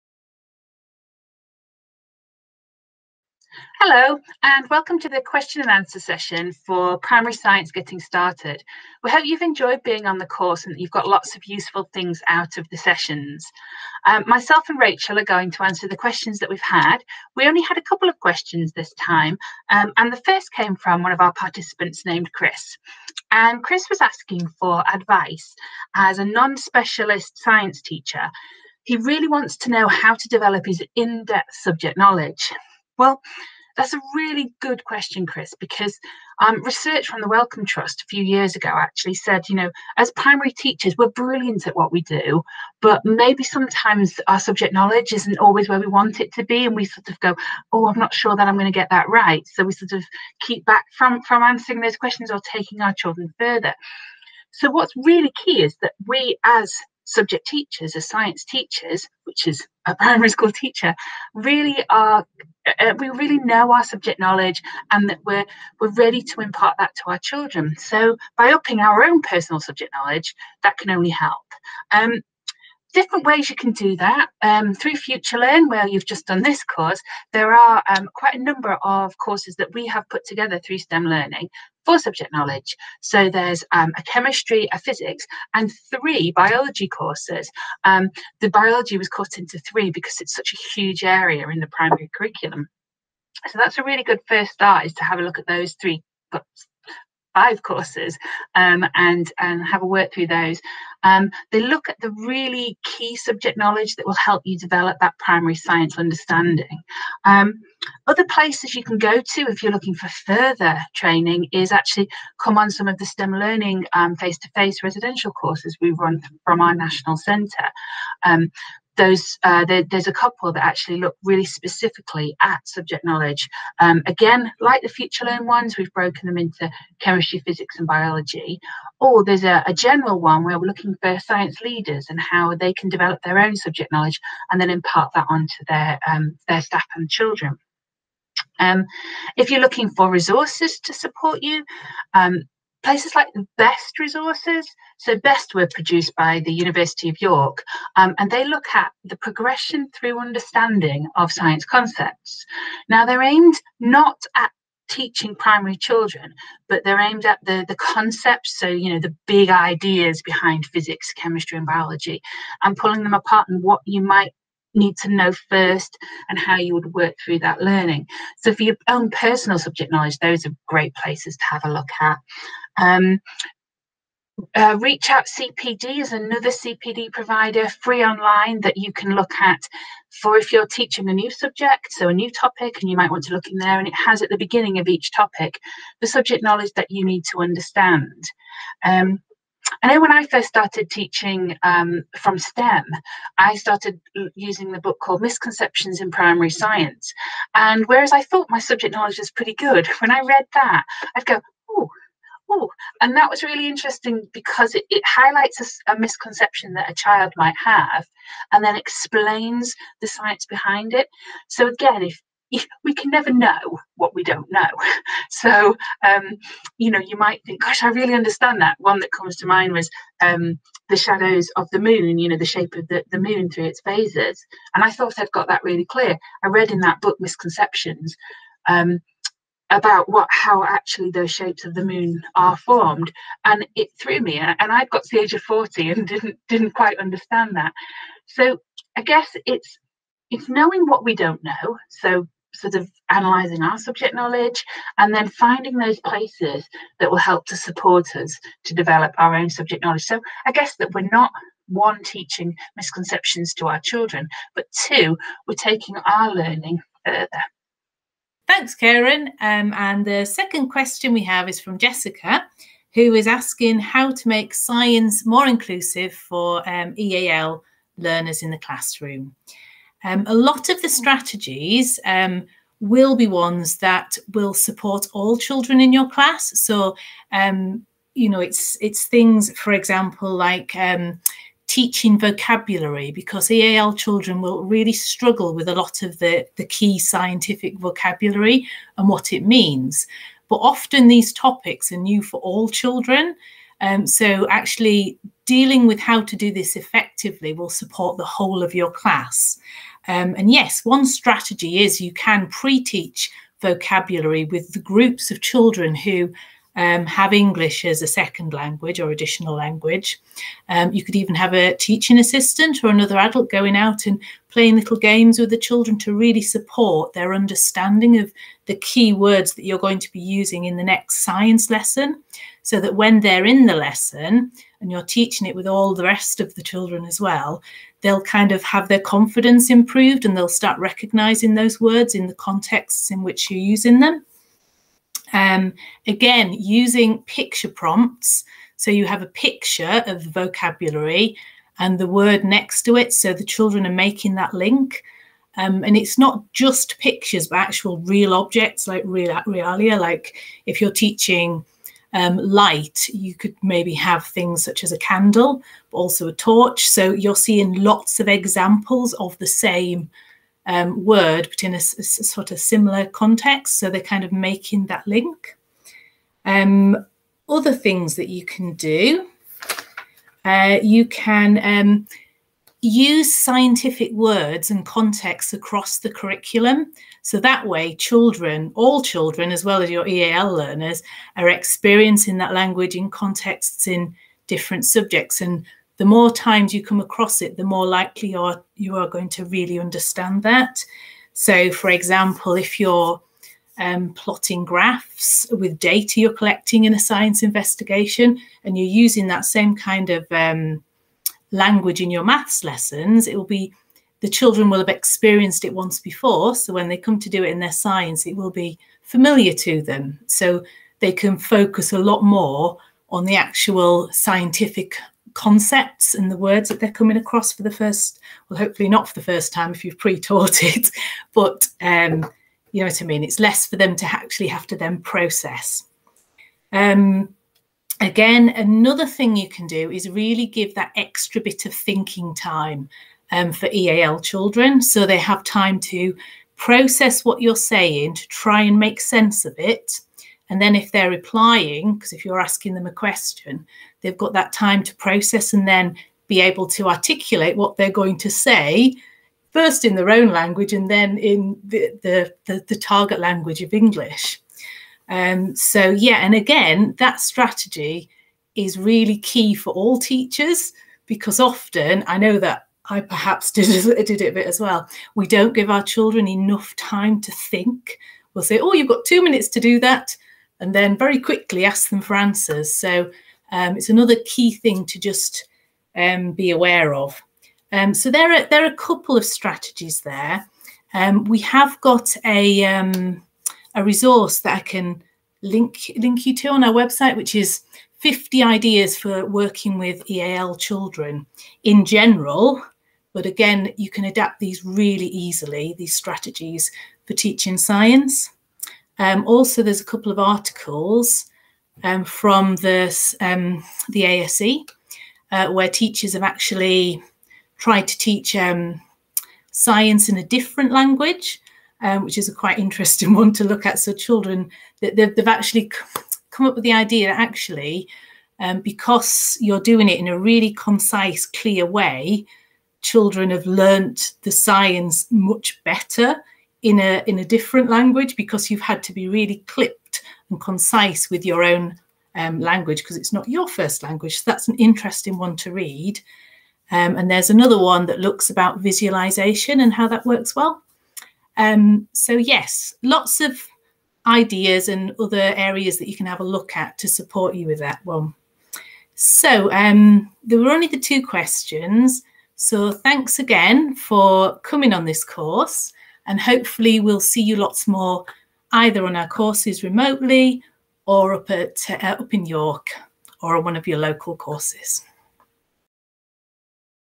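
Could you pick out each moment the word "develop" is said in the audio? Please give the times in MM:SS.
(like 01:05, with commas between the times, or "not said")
00:30, 01:44, 02:12, 04:08.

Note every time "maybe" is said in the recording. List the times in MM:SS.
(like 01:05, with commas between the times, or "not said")
00:43, 05:53.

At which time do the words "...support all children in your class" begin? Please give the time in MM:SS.
04:34.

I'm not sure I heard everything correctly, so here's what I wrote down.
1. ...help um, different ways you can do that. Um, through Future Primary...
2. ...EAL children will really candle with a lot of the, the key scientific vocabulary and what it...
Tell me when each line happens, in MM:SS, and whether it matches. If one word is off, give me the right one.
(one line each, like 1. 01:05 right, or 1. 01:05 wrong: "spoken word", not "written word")
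1. 01:11 wrong: "Learn", not "Primary"
2. 04:43 wrong: "struggle", not "candle".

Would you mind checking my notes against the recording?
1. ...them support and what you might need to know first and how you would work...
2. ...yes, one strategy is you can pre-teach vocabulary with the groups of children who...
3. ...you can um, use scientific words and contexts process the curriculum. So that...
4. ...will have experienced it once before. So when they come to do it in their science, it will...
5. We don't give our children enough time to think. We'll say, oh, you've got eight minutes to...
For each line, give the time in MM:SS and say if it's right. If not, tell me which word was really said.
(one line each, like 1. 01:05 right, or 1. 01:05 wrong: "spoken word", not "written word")
1. 02:43 wrong: "apart", not "support"
2. 05:00 right
3. 06:10 wrong: "across", not "process"
4. 06:44 right
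5. 07:45 wrong: "two", not "eight".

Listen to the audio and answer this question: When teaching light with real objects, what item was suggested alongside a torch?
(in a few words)
A candle.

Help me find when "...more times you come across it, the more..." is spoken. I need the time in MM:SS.
06:26.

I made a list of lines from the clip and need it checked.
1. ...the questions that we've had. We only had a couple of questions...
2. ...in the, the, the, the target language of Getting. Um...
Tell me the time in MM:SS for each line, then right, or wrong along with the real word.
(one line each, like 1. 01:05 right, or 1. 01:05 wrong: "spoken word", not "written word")
1. 00:15 right
2. 07:31 wrong: "English", not "Getting".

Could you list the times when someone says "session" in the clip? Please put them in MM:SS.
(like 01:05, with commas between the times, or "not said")
00:05, 00:12.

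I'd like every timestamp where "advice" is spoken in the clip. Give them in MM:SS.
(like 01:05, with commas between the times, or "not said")
00:24.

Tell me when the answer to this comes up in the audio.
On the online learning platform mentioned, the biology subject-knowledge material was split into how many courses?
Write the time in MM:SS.
01:25.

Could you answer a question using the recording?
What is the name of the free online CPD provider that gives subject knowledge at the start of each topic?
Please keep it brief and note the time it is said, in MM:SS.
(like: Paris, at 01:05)
Reach Out CPD, at 02:54.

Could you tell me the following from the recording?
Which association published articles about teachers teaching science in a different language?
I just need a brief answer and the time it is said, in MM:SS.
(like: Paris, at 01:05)
ASE, at 08:23.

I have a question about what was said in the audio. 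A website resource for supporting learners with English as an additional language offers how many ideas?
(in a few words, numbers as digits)
50.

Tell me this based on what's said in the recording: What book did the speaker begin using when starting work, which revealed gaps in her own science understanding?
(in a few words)
Misconceptions in Primary Science.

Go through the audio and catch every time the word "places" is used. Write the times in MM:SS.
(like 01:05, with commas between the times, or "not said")
01:48, 02:22, 02:50, 04:06.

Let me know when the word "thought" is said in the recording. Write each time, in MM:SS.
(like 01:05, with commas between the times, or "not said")
03:18, 03:44.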